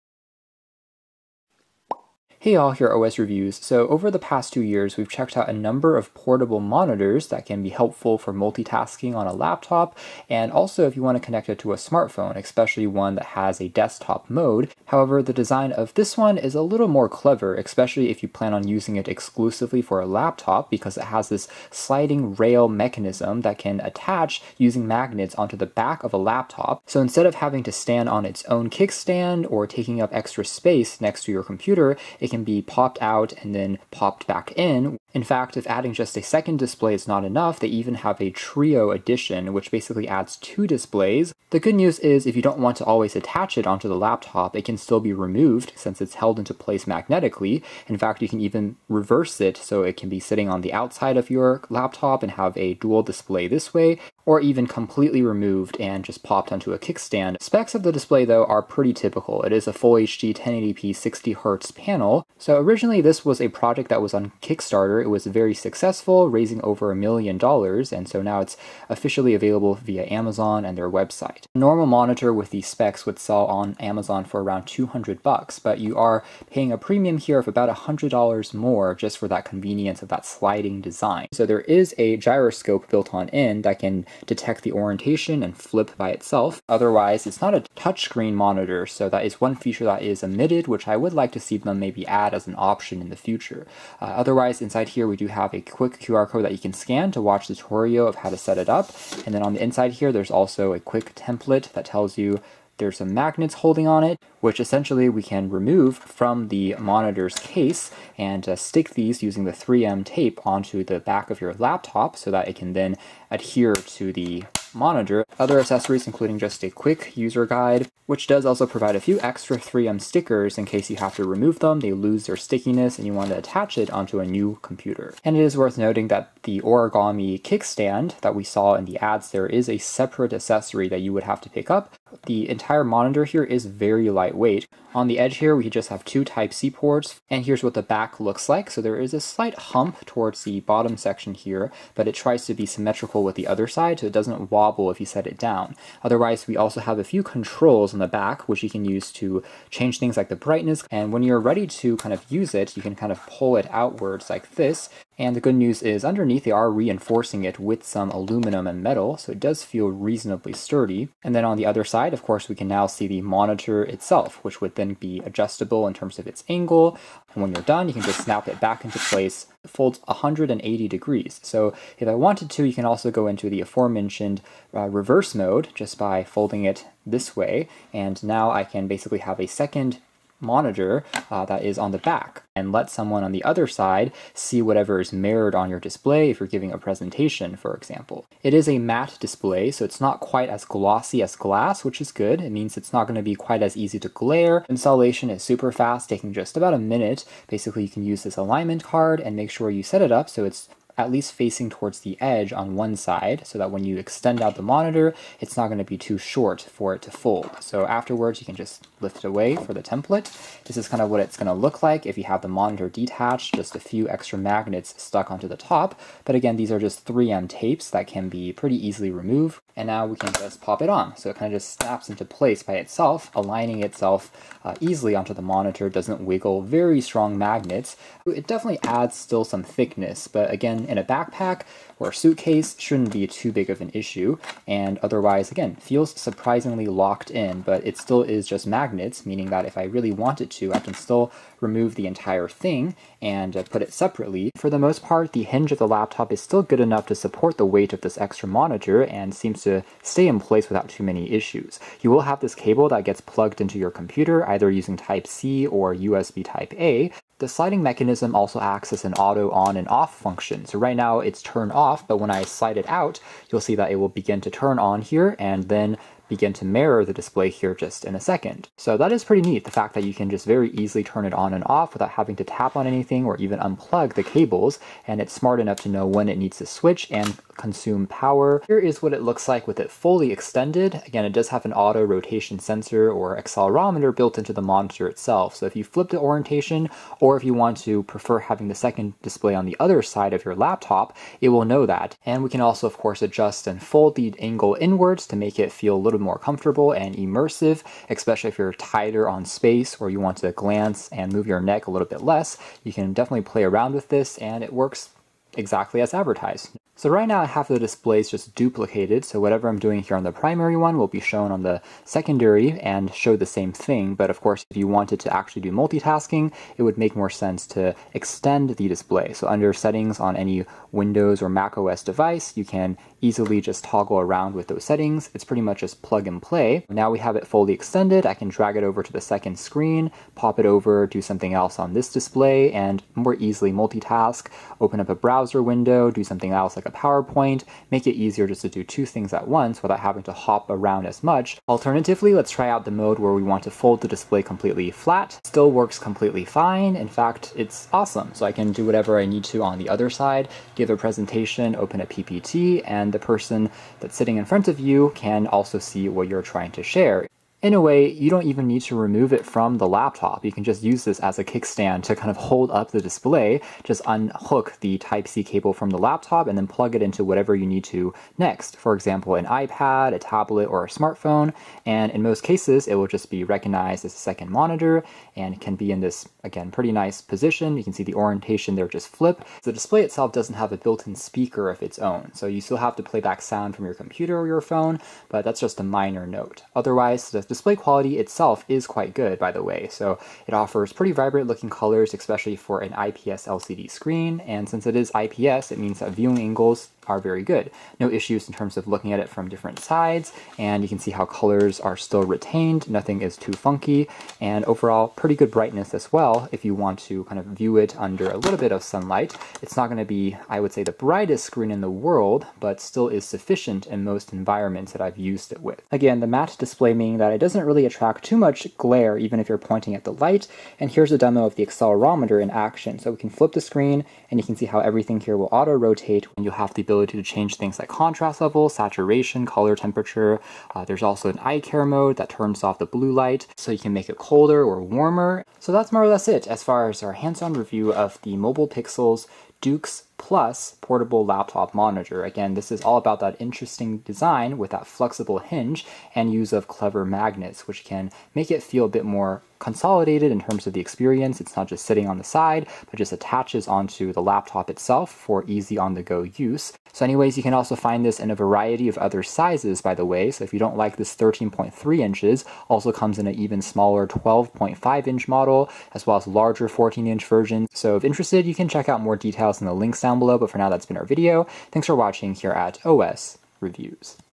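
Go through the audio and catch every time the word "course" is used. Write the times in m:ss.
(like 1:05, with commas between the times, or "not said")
2:42, 4:52, 5:14.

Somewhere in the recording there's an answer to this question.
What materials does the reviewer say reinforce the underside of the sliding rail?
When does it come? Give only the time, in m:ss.
2:38.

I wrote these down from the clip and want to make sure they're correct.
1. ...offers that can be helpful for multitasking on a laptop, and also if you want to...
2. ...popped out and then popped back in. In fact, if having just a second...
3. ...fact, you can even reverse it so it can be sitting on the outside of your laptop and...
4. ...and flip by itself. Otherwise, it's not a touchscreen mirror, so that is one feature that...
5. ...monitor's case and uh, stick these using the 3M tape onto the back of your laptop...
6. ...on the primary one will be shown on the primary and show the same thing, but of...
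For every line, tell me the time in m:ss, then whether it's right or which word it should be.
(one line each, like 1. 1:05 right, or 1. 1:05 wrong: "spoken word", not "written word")
1. 0:06 wrong: "monitors", not "offers"
2. 0:32 wrong: "adding", not "having"
3. 0:47 right
4. 1:25 wrong: "monitor", not "mirror"
5. 1:46 right
6. 5:10 wrong: "secondary", not "primary".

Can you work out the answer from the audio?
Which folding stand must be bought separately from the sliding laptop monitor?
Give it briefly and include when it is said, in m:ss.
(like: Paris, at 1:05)
origami kickstand, at 2:06.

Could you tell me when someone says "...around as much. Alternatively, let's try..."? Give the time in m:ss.
5:40.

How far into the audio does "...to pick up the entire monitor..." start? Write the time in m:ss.
2:11.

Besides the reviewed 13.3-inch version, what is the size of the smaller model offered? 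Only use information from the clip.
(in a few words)
12.5 inch.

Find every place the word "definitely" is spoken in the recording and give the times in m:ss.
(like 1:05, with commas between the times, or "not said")
3:48, 5:03.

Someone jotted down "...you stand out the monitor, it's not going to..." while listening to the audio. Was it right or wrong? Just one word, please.
wrong.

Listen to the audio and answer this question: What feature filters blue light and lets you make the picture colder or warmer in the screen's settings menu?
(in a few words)
eye care mode.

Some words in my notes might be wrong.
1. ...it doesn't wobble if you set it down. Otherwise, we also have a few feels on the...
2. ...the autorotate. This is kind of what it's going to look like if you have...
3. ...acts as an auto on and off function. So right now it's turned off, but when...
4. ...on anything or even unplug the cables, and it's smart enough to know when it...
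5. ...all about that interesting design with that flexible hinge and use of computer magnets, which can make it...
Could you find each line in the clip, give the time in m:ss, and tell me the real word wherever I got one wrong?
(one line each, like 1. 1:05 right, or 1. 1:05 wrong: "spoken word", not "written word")
1. 2:24 wrong: "controls", not "feels"
2. 3:29 wrong: "template", not "autorotate"
3. 4:18 right
4. 4:32 right
5. 7:22 wrong: "clever", not "computer".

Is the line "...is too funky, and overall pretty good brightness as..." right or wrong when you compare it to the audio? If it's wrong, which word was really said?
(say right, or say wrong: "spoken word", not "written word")
right.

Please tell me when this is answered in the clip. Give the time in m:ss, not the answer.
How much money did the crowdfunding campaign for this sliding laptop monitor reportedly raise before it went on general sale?
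1:06.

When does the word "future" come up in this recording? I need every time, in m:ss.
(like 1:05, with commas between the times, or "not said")
1:33.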